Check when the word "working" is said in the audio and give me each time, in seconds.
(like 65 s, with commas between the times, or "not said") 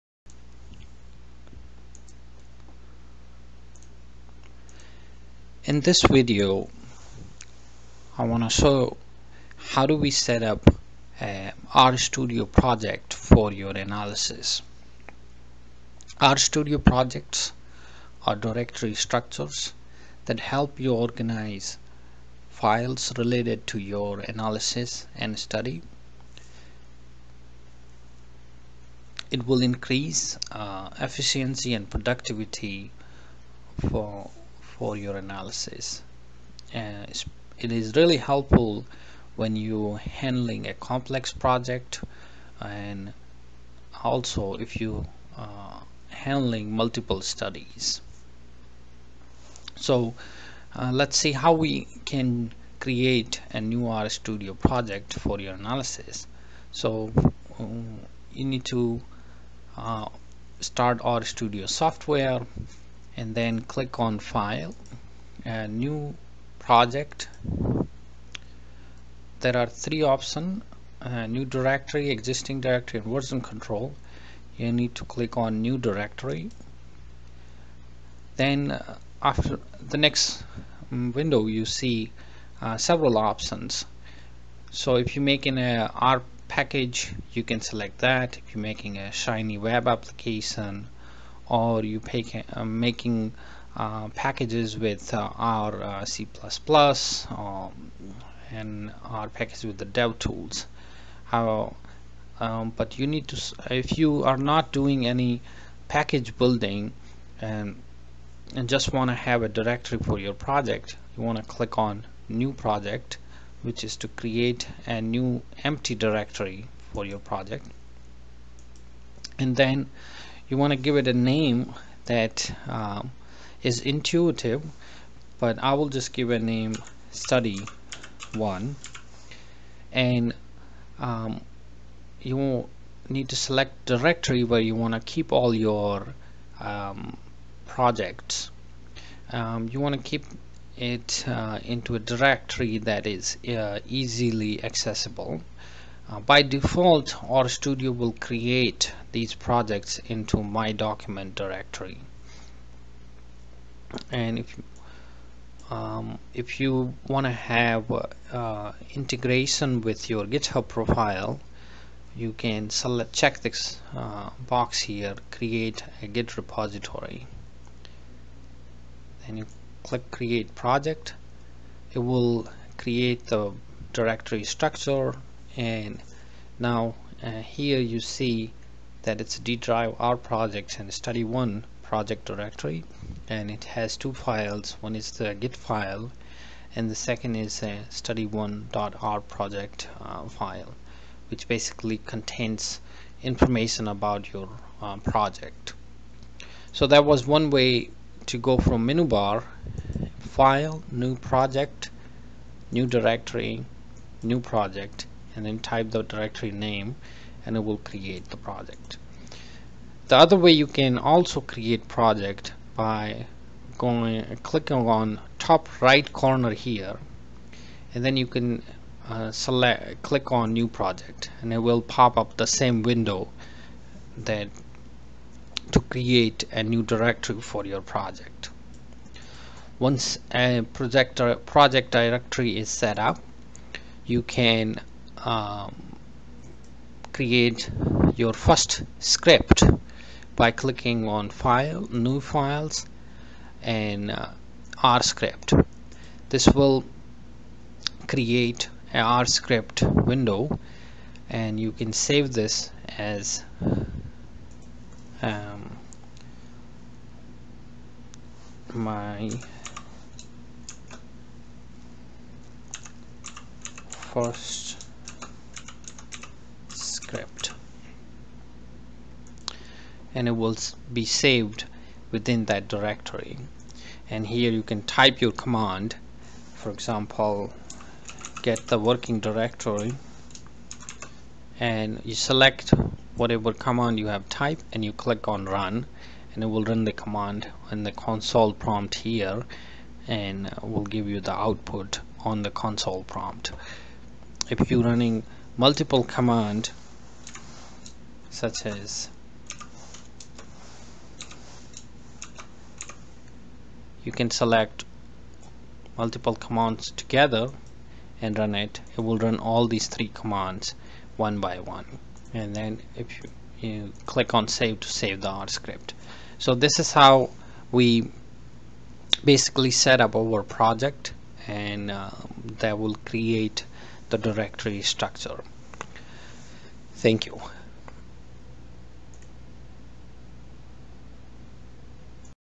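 278 s.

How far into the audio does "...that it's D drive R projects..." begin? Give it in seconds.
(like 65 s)
179 s.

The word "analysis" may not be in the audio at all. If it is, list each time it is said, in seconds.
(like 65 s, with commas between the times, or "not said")
13 s, 24 s, 35 s, 55 s.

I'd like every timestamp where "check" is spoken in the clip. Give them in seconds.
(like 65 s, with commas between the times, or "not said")
163 s.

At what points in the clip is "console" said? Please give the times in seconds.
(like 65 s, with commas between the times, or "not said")
287 s, 292 s.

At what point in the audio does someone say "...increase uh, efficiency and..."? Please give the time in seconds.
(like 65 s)
29 s.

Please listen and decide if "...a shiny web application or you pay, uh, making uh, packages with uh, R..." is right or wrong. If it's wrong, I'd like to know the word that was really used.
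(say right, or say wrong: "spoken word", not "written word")
right.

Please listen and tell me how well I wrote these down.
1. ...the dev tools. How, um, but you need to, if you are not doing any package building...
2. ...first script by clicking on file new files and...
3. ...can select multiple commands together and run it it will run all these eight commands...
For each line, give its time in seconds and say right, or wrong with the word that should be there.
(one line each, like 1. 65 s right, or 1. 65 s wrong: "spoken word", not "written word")
1. 99 s right
2. 238 s right
3. 304 s wrong: "three", not "eight".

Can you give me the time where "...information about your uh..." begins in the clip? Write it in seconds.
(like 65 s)
193 s.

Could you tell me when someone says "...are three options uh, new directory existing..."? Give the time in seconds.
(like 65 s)
69 s.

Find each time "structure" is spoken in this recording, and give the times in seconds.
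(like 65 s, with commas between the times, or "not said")
18 s, 174 s, 324 s.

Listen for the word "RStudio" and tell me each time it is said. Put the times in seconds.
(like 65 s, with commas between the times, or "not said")
11 s, 16 s, 53 s, 61 s, 147 s.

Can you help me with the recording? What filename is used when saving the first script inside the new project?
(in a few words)
my first script.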